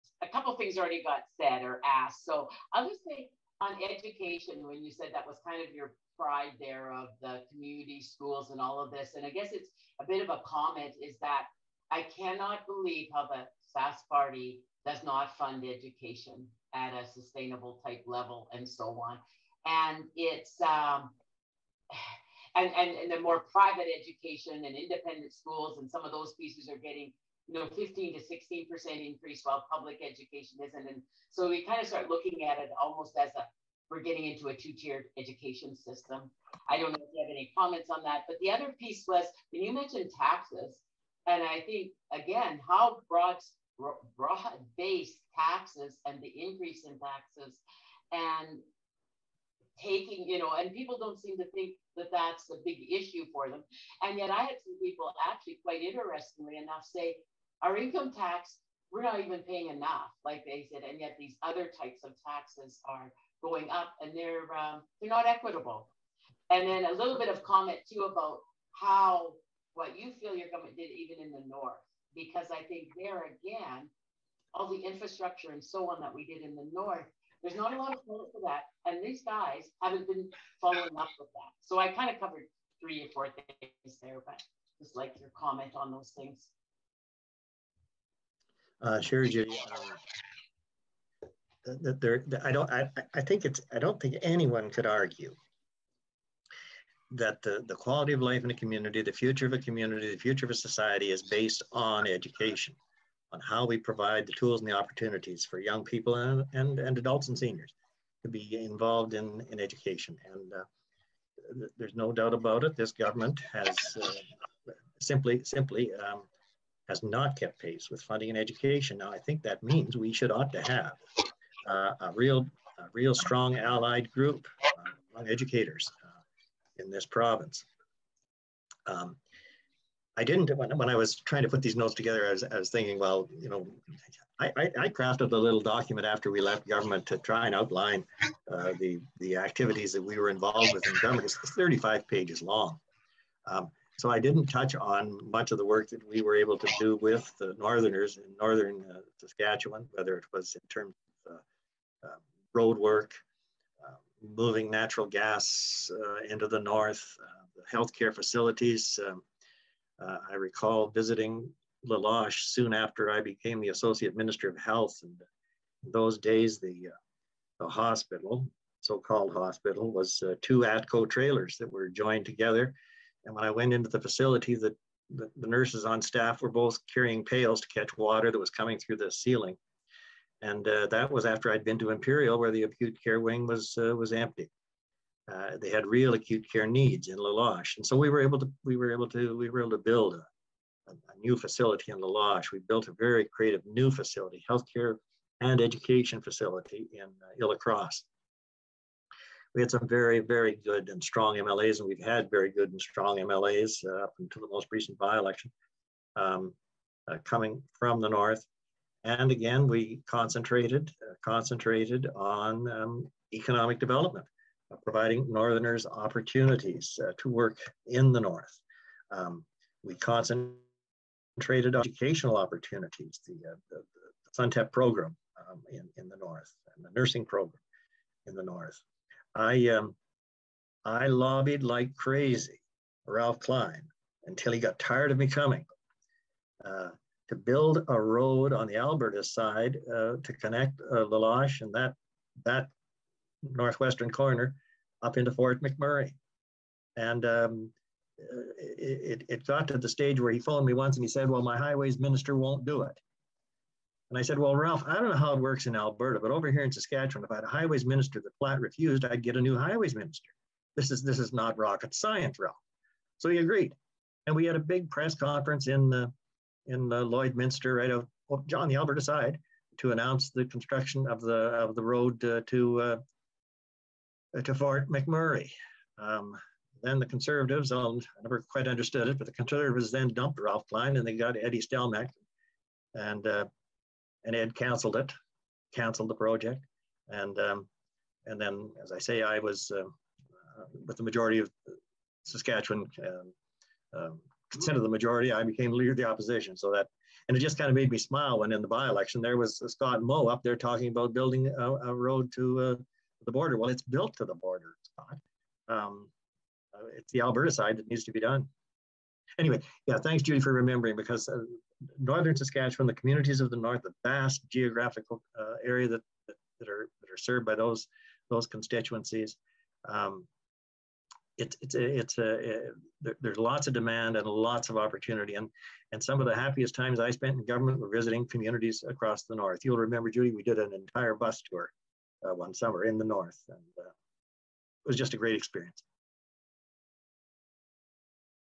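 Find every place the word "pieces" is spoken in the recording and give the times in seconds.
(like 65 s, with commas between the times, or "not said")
26 s, 38 s.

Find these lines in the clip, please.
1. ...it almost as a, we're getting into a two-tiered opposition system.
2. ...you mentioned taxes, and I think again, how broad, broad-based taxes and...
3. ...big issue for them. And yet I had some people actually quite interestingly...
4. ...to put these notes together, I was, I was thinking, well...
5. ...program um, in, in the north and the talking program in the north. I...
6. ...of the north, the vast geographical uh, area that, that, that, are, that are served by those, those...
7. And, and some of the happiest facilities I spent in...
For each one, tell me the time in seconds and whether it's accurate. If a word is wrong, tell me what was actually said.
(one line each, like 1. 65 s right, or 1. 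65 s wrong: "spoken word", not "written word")
1. 32 s wrong: "education", not "opposition"
2. 39 s right
3. 52 s right
4. 131 s right
5. 224 s wrong: "nursing", not "talking"
6. 313 s right
7. 325 s wrong: "times", not "facilities".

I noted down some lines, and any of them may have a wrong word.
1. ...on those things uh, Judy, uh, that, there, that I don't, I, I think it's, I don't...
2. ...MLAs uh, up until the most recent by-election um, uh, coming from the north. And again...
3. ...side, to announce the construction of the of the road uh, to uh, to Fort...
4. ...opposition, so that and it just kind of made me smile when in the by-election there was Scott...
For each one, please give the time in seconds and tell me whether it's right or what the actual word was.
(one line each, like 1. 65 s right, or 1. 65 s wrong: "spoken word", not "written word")
1. 85 s right
2. 203 s right
3. 268 s right
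4. 296 s right.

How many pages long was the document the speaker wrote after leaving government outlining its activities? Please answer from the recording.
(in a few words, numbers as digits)
35.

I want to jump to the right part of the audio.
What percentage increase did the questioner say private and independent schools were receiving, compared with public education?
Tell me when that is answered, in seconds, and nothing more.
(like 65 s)
27 s.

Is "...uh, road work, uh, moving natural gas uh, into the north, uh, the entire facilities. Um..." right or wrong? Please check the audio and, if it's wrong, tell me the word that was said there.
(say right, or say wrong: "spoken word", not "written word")
wrong: "healthcare", not "entire".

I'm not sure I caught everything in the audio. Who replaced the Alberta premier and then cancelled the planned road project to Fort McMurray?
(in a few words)
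Eddie Stelmach.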